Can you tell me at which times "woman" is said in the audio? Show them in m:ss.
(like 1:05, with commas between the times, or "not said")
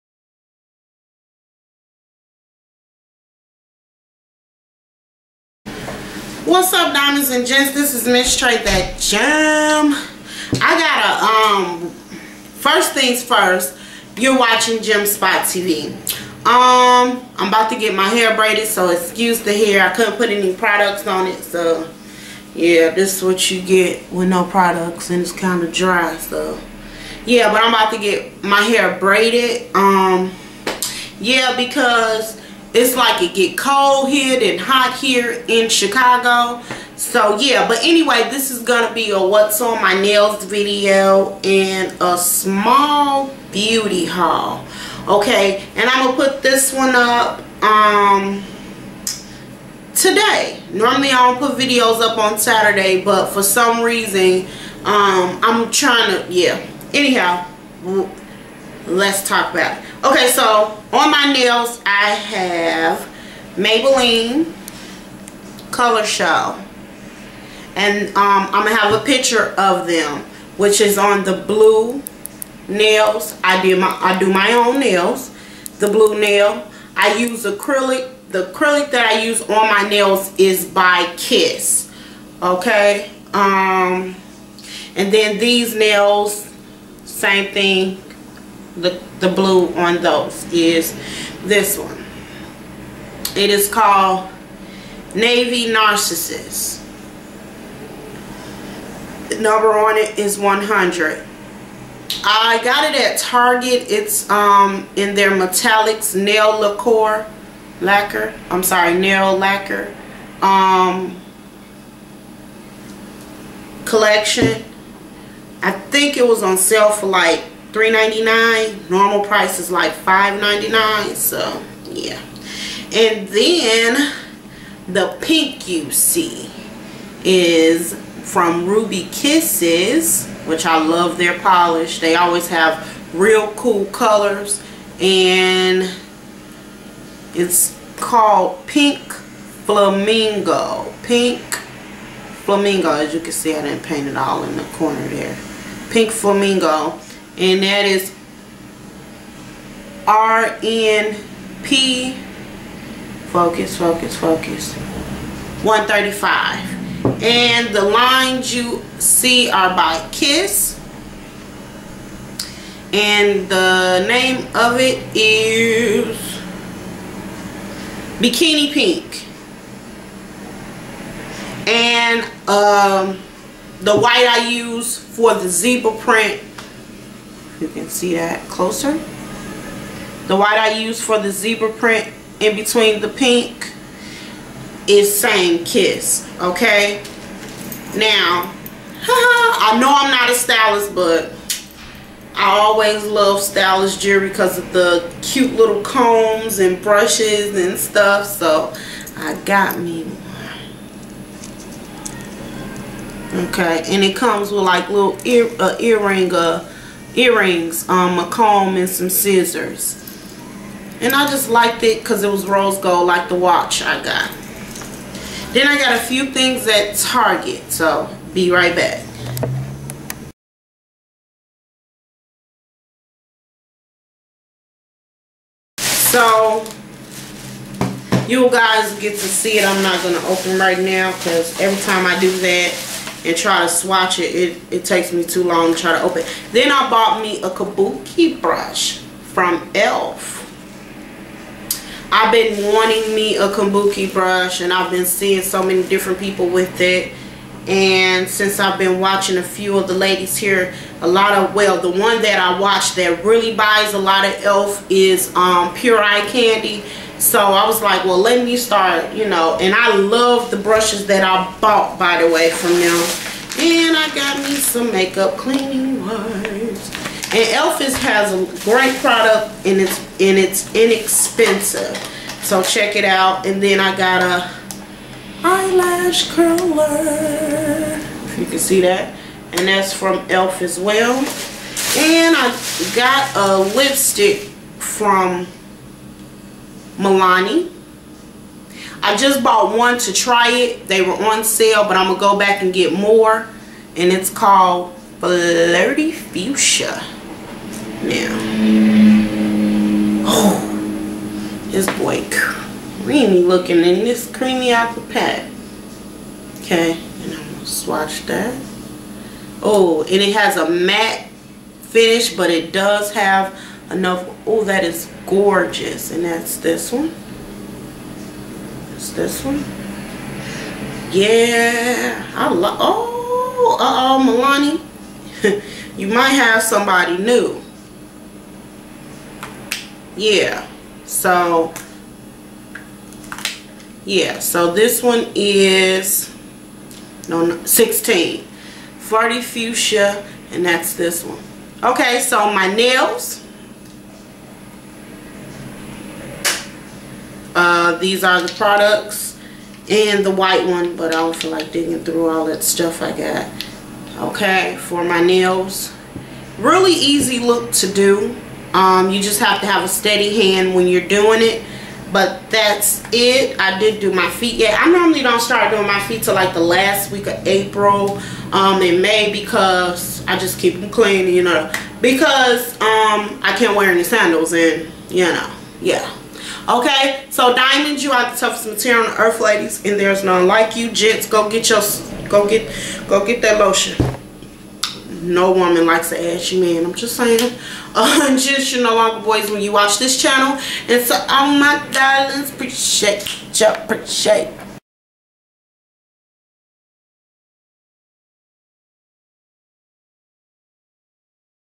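6:25.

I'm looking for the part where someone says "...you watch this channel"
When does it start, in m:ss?
6:29.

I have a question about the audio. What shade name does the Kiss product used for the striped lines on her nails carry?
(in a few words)
Bikini Pink.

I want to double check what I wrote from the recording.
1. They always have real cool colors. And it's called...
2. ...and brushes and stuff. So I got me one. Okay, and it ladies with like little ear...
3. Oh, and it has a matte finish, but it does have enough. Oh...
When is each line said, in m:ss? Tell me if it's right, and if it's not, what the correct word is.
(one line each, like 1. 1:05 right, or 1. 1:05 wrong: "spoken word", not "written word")
1. 2:11 right
2. 3:16 wrong: "comes", not "ladies"
3. 5:09 right.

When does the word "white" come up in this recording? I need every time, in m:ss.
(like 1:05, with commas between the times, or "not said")
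2:53, 3:00, 5:50.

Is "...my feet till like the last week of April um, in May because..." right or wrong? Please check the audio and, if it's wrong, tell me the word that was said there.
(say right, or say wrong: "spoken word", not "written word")
right.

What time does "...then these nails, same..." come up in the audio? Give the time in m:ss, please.
1:25.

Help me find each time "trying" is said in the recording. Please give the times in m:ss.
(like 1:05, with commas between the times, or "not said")
0:55.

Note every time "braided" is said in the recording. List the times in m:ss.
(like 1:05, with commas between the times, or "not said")
0:18, 0:28.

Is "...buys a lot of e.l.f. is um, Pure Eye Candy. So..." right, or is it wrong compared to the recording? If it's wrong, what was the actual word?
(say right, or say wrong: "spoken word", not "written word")
right.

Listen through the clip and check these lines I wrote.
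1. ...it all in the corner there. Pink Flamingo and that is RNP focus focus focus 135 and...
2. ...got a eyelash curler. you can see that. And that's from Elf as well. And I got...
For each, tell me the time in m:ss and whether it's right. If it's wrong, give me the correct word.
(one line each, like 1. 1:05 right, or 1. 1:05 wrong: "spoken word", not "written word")
1. 2:24 right
2. 4:33 right.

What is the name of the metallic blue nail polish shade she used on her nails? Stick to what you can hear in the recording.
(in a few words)
Navy Narcissus.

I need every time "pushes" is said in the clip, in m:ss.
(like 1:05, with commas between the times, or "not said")
not said.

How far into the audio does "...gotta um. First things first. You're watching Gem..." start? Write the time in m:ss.
0:10.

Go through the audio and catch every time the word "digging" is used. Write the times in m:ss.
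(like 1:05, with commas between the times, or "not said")
5:51.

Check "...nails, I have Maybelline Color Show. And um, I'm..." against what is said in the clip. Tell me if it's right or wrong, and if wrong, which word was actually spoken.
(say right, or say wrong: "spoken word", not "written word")
right.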